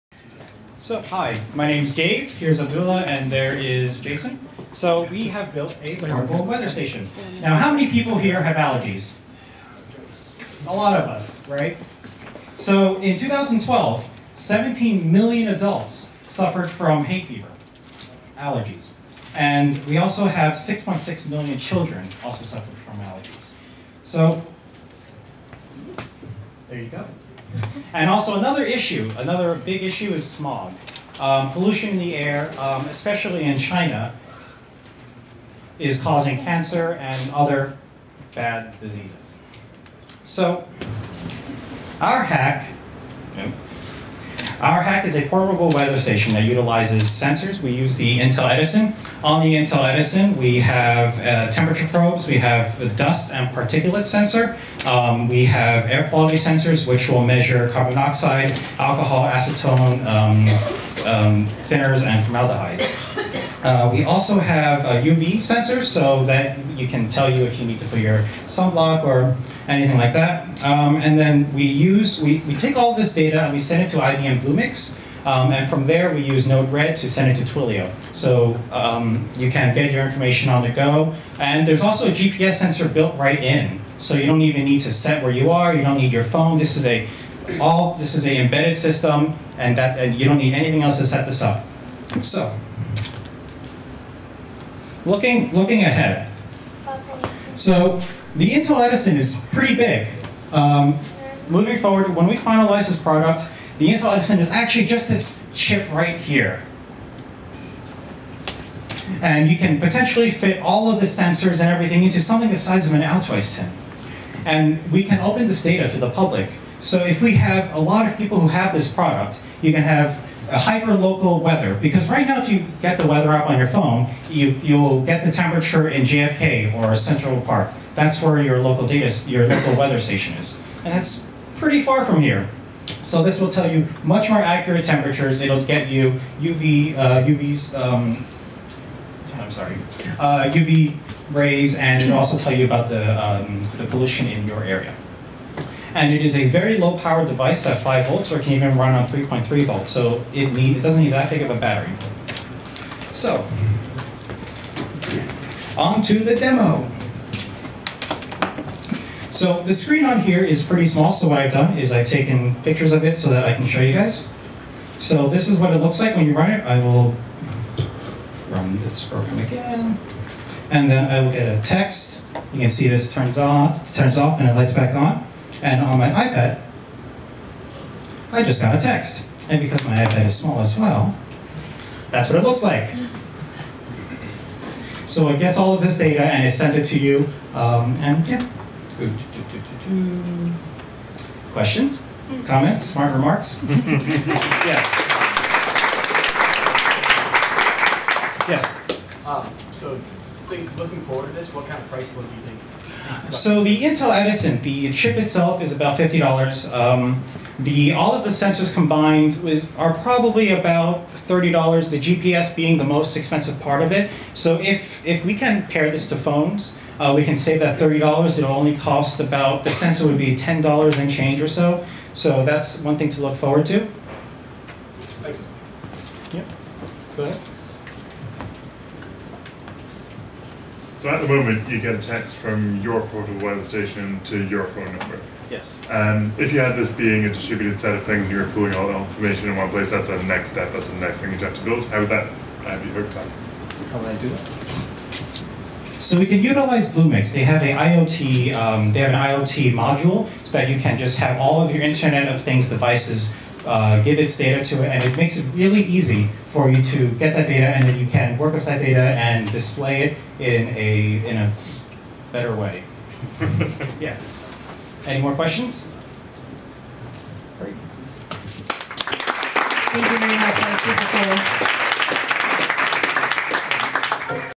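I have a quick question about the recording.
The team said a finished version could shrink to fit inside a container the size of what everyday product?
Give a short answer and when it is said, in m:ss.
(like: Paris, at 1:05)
Altoids tin, at 1:53.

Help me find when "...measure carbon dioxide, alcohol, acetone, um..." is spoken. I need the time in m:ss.
0:57.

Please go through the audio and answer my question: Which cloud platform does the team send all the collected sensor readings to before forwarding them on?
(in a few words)
IBM Bluemix.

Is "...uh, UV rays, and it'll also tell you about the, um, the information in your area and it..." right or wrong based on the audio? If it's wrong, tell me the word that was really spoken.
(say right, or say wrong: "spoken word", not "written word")
wrong: "pollution", not "information".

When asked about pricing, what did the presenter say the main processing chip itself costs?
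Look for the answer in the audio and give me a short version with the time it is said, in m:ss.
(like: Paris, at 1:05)
$50, at 3:25.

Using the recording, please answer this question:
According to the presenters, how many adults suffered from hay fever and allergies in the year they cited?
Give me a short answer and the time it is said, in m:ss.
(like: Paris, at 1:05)
17 million, at 0:14.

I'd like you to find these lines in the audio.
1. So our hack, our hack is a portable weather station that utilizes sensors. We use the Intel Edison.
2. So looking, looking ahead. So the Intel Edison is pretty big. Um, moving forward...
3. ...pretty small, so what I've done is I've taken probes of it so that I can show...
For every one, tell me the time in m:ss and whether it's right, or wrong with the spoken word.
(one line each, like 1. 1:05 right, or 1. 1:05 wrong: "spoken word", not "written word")
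1. 0:40 right
2. 1:32 right
3. 2:40 wrong: "pictures", not "probes".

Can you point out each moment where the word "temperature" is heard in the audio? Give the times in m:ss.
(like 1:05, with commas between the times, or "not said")
0:51, 2:05, 2:14.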